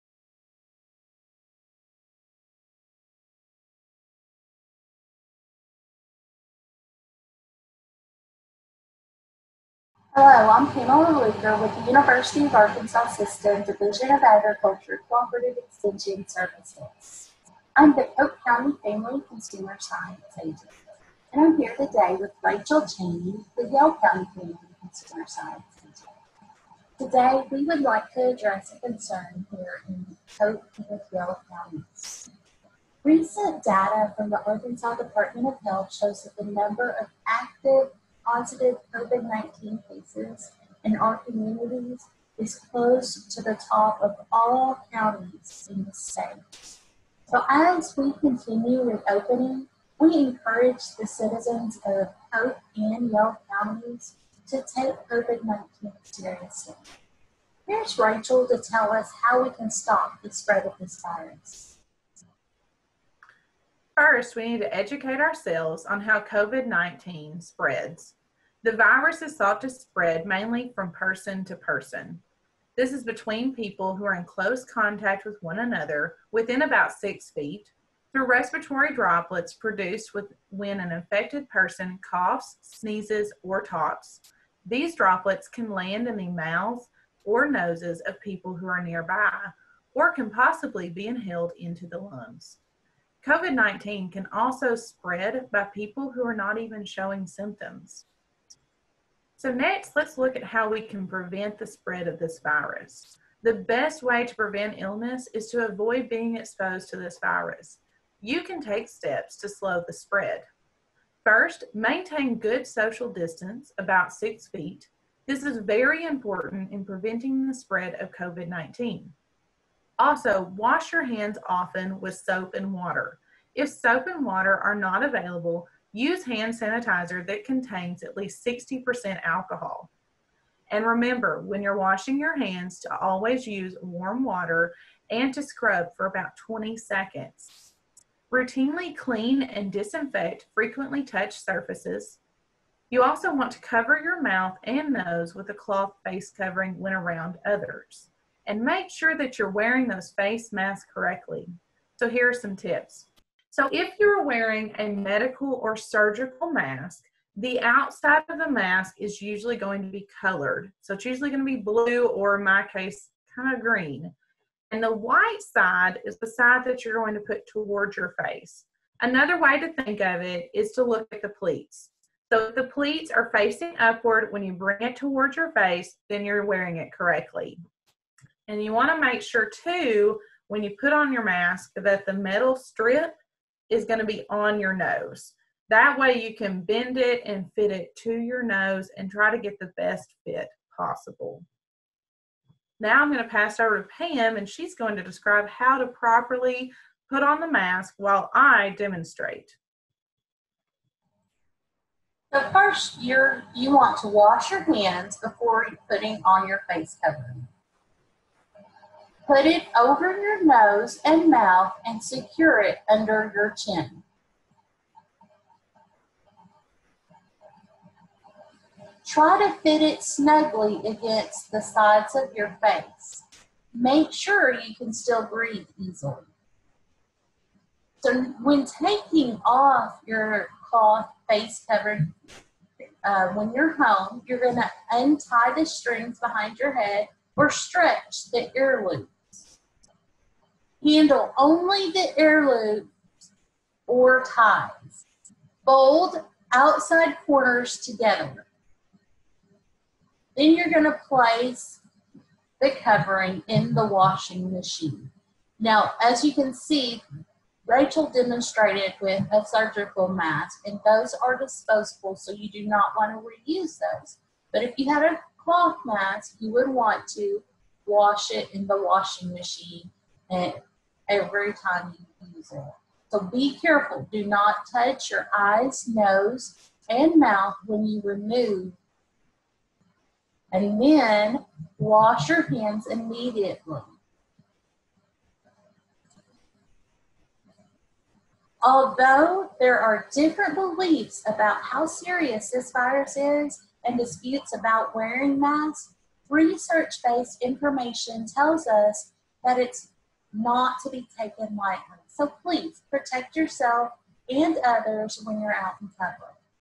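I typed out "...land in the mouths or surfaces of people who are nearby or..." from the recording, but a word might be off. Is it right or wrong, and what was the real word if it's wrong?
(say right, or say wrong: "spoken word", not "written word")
wrong: "noses", not "surfaces".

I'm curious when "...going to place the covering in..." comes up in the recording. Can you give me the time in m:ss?
4:10.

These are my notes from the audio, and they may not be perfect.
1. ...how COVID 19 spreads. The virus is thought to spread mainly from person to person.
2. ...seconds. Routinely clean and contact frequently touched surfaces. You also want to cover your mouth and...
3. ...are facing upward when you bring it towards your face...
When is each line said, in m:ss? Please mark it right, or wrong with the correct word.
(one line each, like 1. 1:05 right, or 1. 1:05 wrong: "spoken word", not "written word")
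1. 1:06 right
2. 2:16 wrong: "disinfect", not "contact"
3. 2:53 right.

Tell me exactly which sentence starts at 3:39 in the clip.
Try to fit it snugly against the sides of your face.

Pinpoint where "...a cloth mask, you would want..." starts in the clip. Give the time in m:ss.
4:25.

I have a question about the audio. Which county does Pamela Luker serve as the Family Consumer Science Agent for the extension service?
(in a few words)
Pope County.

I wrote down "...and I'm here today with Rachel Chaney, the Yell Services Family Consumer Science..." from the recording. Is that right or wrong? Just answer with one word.
wrong.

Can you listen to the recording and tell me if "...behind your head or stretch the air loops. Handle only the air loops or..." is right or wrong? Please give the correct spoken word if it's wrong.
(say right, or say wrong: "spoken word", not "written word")
right.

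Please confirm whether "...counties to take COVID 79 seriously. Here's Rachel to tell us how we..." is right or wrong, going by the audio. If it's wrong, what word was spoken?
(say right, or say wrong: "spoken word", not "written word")
wrong: "19", not "79".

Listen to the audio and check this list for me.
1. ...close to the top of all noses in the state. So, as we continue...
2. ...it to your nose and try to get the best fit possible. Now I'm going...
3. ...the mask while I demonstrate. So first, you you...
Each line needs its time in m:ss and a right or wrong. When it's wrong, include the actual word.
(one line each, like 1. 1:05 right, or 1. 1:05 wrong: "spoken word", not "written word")
1. 0:42 wrong: "counties", not "noses"
2. 3:07 right
3. 3:17 right.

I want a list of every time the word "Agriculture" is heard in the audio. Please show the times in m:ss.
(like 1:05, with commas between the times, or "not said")
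0:14.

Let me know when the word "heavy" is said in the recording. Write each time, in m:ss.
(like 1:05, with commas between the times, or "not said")
not said.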